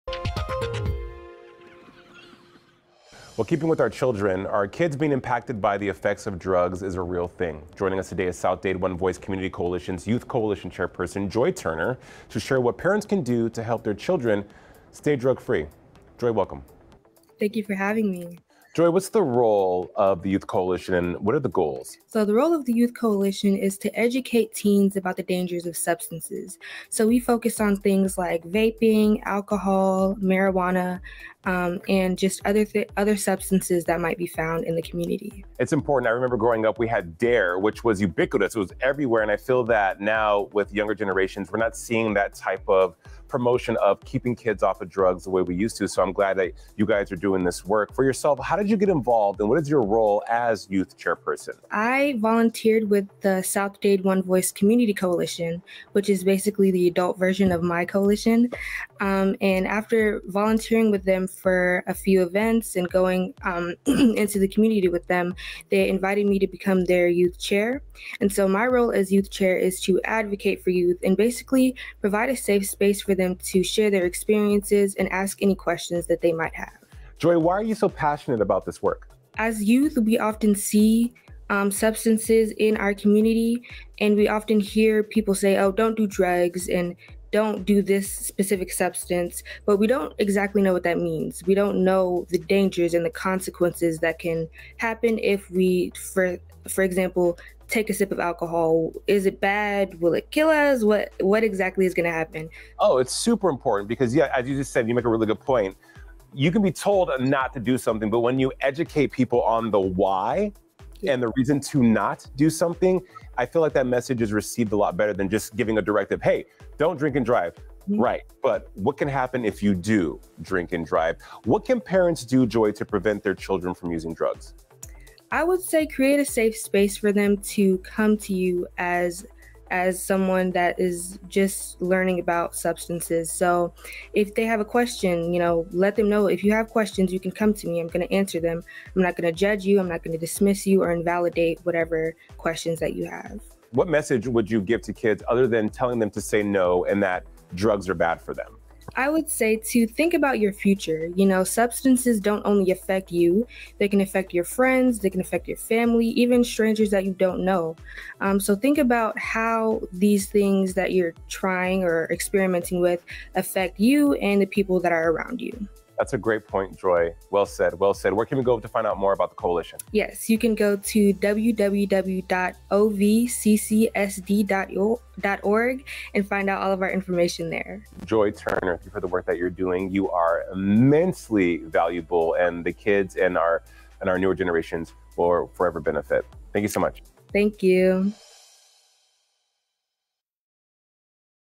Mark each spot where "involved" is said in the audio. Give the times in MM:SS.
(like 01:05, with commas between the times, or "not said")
00:48.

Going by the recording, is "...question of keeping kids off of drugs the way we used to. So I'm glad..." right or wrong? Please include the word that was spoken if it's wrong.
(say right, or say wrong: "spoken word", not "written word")
wrong: "promotion", not "question".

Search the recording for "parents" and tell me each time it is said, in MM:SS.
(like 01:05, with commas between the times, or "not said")
00:12, 02:01.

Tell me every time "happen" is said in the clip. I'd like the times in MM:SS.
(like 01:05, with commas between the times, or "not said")
01:34, 01:42, 01:59.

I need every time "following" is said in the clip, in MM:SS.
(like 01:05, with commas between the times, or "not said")
not said.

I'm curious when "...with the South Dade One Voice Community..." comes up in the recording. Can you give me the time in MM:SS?
00:52.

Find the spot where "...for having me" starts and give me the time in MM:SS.
00:17.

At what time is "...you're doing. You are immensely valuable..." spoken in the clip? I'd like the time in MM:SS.
02:59.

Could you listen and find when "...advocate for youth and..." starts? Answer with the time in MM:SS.
01:10.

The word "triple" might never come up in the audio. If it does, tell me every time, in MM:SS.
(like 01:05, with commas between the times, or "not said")
not said.